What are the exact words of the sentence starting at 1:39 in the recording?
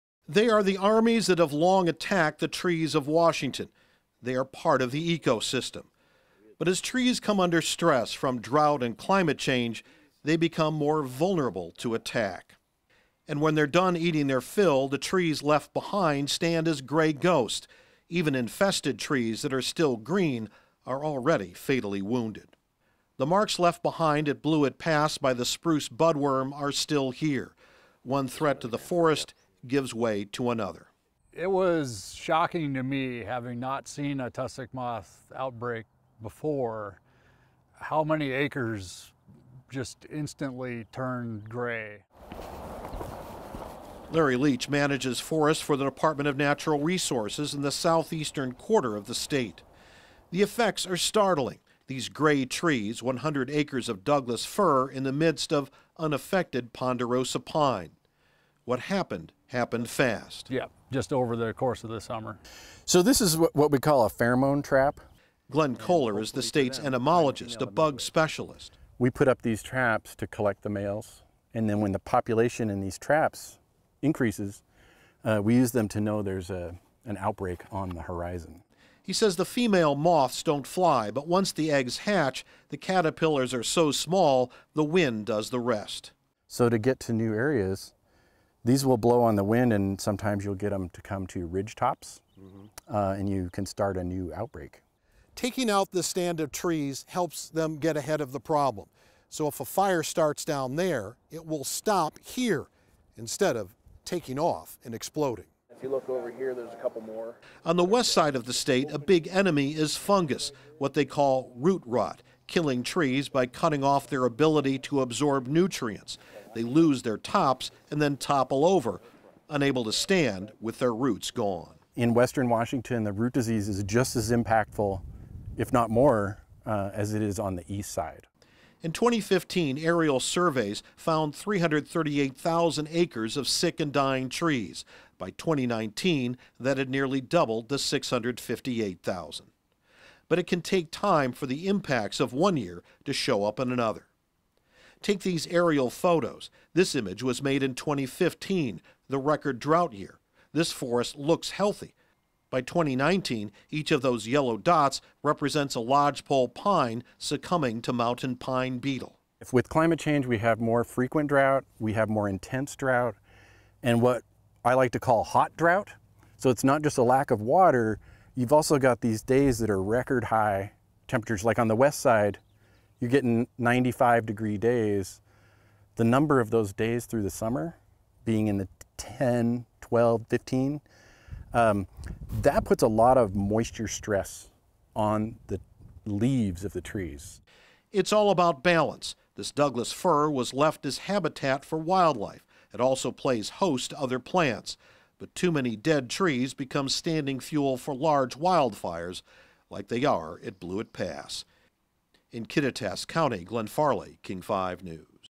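So if a fire starts down there, it will stop here instead of taking off and exploding.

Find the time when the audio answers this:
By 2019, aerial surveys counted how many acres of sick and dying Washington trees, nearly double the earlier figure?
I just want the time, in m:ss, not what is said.
2:17.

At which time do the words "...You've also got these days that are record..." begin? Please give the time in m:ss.
2:48.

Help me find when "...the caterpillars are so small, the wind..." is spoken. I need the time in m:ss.
1:22.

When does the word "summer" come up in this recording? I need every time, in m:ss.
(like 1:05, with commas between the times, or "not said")
1:01, 2:57.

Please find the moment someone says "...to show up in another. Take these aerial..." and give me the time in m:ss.
2:23.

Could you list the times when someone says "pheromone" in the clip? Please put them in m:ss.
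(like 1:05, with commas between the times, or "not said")
1:04.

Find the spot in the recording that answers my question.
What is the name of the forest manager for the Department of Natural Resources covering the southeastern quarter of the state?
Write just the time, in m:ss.
0:44.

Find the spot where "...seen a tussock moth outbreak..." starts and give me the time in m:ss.
0:33.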